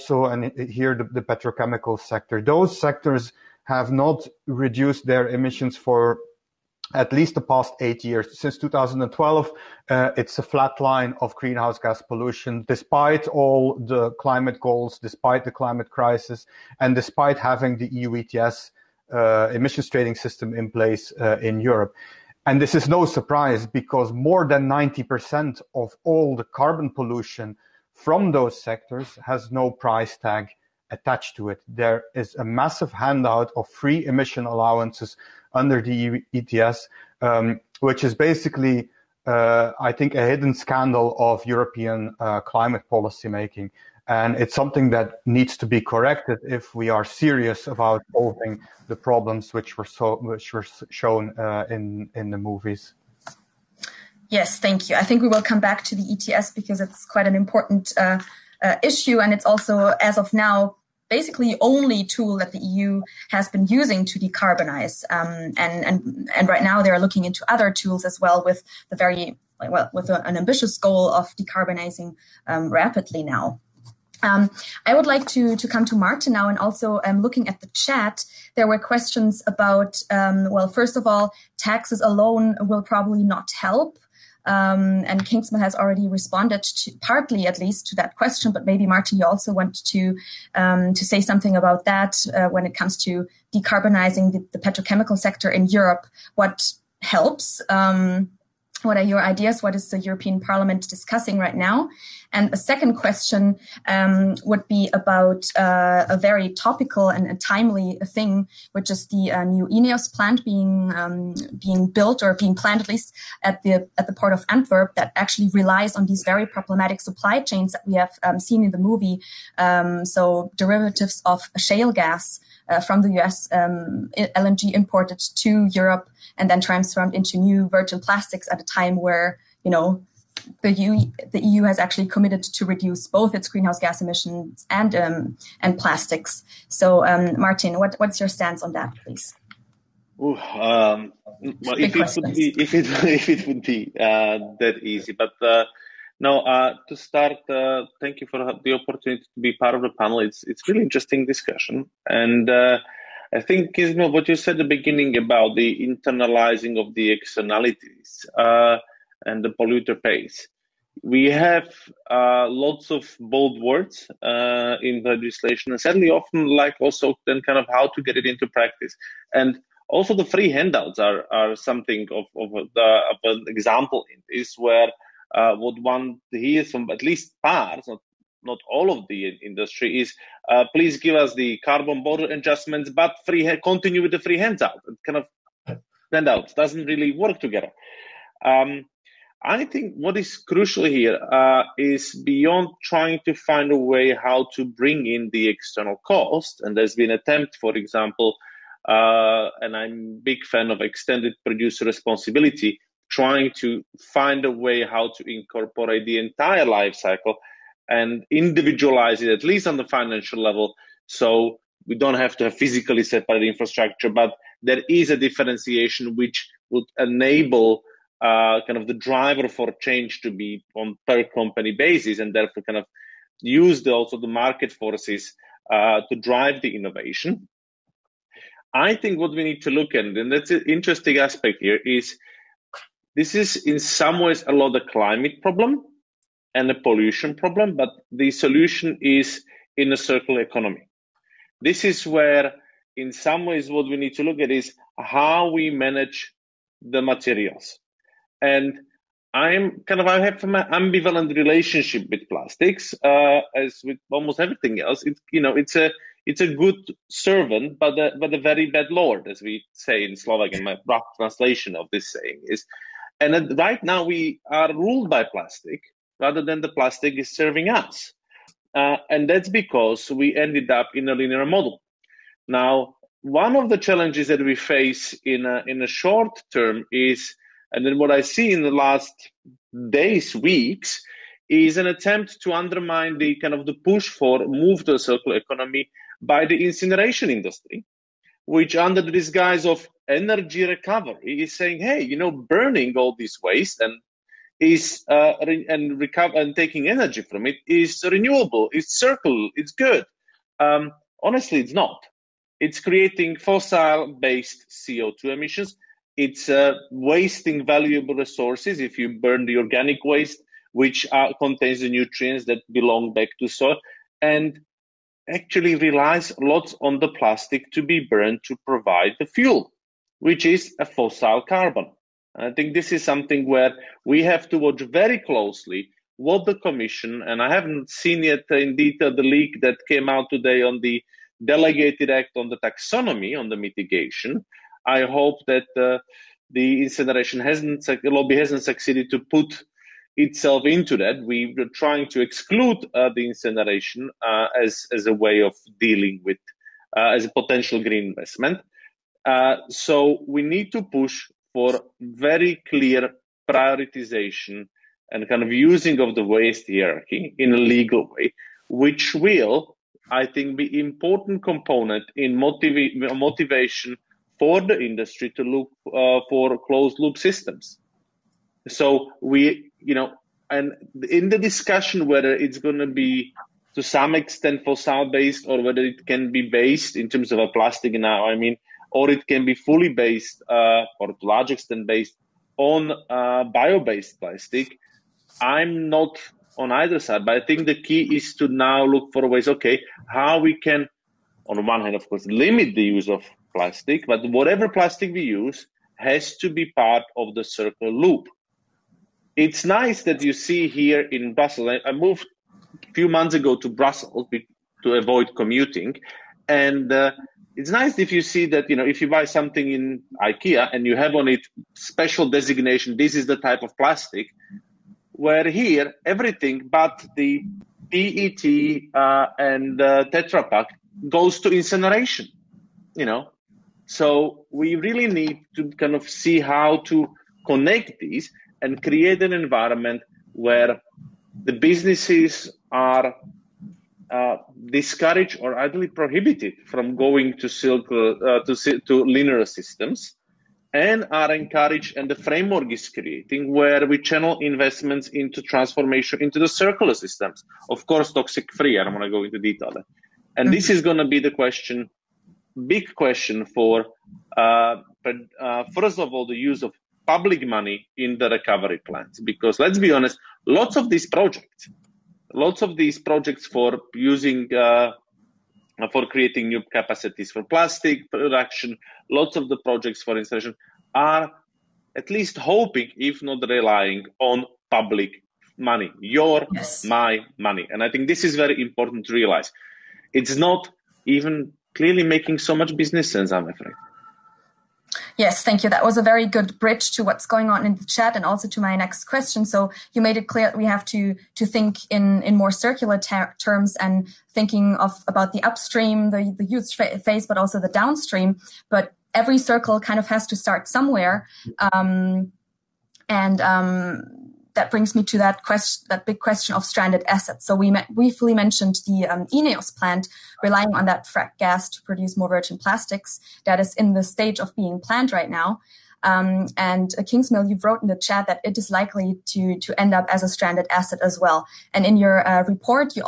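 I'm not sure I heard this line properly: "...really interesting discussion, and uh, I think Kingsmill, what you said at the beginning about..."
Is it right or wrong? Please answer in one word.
right.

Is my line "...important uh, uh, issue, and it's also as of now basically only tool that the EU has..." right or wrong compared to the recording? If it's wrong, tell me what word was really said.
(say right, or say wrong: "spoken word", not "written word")
right.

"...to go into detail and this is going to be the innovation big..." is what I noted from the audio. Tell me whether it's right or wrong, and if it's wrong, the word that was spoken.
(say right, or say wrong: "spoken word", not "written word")
wrong: "question", not "innovation".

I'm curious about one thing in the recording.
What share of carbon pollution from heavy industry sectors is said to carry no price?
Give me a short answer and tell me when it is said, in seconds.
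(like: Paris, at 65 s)
more than 90%, at 24 s.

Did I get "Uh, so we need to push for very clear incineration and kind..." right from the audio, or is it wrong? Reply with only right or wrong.
wrong.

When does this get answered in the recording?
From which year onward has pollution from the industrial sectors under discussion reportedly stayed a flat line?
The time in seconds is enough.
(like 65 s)
8 s.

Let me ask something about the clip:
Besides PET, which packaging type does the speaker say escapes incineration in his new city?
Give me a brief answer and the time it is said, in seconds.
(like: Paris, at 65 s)
Tetra Pak, at 420 s.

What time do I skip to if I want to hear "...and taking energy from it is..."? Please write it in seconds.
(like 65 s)
296 s.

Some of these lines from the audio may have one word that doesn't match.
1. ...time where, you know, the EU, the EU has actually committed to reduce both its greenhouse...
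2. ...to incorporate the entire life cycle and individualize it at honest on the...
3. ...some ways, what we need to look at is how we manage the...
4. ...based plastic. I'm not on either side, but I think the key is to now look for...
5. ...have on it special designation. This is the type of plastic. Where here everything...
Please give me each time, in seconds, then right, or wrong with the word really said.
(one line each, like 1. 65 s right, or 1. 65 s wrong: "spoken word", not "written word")
1. 128 s right
2. 205 s wrong: "least", not "honest"
3. 243 s right
4. 383 s right
5. 410 s right.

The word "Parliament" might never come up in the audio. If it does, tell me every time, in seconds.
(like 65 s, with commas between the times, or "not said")
100 s.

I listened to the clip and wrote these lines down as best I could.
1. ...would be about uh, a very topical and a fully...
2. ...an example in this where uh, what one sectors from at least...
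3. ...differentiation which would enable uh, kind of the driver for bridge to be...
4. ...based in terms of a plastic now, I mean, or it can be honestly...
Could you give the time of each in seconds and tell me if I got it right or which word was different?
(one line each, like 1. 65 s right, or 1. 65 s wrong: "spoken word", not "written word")
1. 104 s wrong: "timely", not "fully"
2. 173 s wrong: "hears", not "sectors"
3. 215 s wrong: "change", not "bridge"
4. 376 s wrong: "fully", not "honestly".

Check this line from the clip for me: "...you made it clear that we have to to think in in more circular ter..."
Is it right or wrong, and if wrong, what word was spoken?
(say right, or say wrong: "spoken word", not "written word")
right.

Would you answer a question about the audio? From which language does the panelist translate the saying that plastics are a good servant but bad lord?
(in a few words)
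Slovak.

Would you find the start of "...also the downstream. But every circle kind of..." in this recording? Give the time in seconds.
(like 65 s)
497 s.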